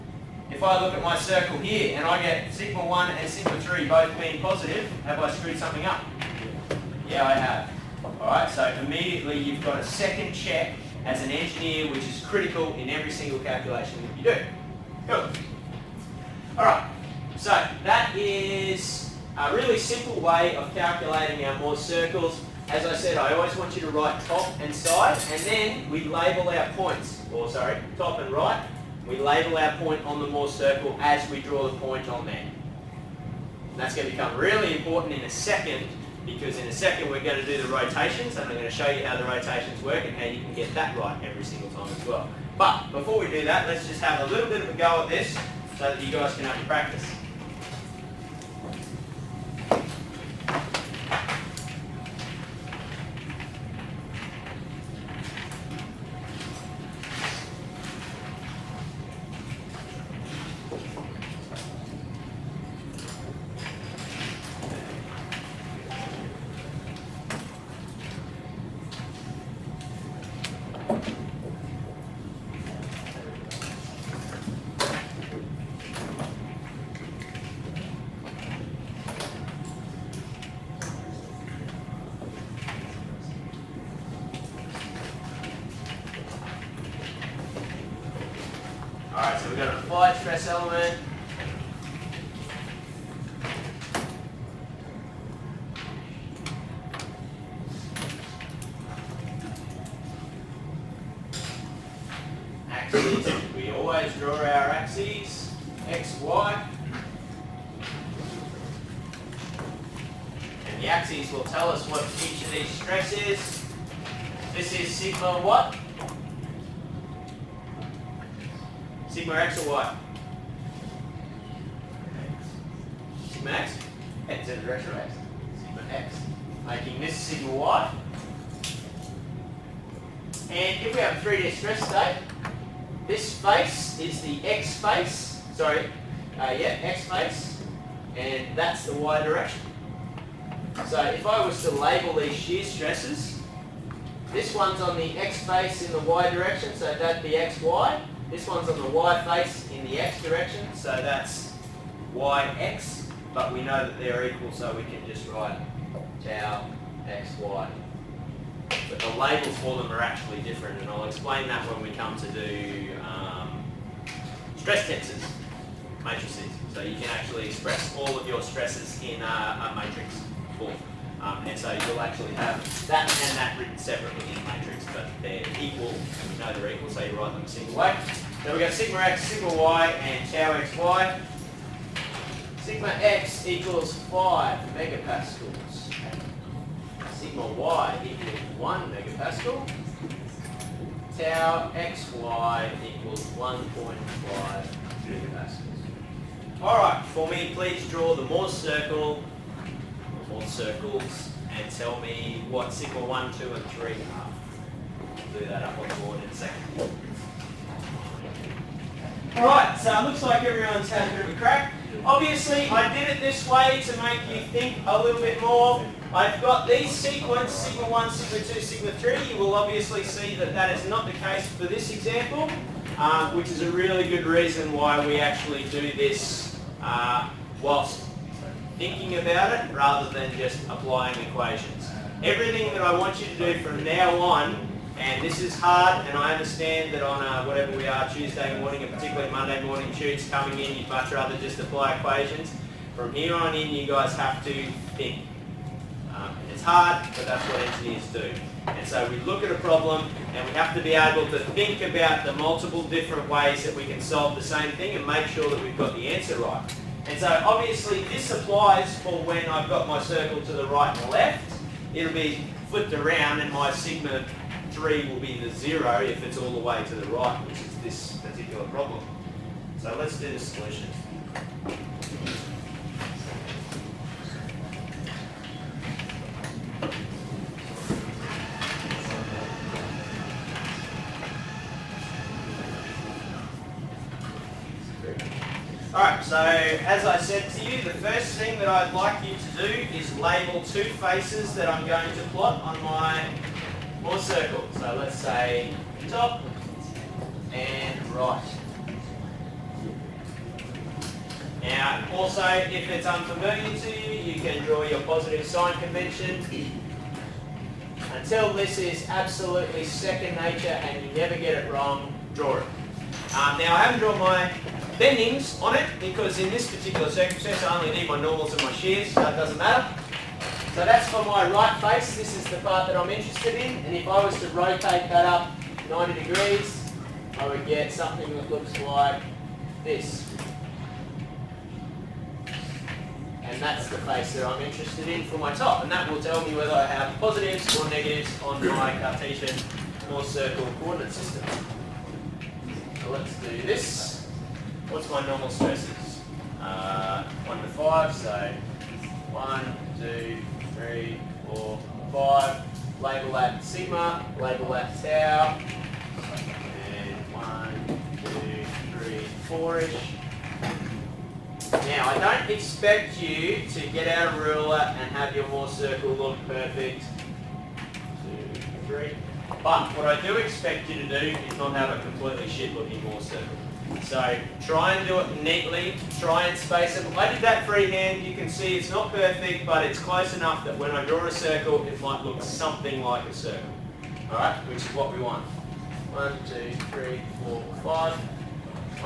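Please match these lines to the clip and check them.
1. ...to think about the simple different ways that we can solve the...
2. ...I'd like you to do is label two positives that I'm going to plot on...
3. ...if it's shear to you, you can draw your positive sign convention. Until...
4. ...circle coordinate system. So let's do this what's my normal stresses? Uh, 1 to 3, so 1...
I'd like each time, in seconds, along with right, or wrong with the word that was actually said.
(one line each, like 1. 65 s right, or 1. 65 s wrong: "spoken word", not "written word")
1. 251 s wrong: "multiple", not "simple"
2. 288 s wrong: "faces", not "positives"
3. 302 s wrong: "unfamiliar", not "shear"
4. 340 s wrong: "5", not "3".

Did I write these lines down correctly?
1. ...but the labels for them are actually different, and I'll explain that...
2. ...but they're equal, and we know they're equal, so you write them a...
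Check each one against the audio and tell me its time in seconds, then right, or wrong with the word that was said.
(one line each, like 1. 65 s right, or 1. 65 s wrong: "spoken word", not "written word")
1. 158 s right
2. 174 s right.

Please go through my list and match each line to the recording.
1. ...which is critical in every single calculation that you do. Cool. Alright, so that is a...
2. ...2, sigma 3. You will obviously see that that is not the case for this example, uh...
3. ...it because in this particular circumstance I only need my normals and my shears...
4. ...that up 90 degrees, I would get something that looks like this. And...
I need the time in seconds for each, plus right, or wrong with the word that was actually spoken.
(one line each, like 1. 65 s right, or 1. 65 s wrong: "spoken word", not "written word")
1. 11 s right
2. 218 s right
3. 315 s right
4. 325 s right.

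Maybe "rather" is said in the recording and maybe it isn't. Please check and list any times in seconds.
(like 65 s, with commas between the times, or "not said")
229 s, 241 s.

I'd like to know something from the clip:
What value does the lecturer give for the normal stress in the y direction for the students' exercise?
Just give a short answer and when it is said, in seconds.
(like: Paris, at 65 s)
1 megapascal, at 187 s.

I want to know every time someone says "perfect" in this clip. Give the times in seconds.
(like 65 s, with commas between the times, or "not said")
366 s, 379 s.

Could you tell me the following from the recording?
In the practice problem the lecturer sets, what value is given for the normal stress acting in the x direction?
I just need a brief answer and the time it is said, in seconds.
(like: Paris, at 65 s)
5 megapascals, at 182 s.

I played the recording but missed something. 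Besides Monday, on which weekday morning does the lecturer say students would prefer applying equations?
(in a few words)
Tuesday.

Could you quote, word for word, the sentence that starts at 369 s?
But what I do expect you to do is not have a completely shit looking Mohr circle.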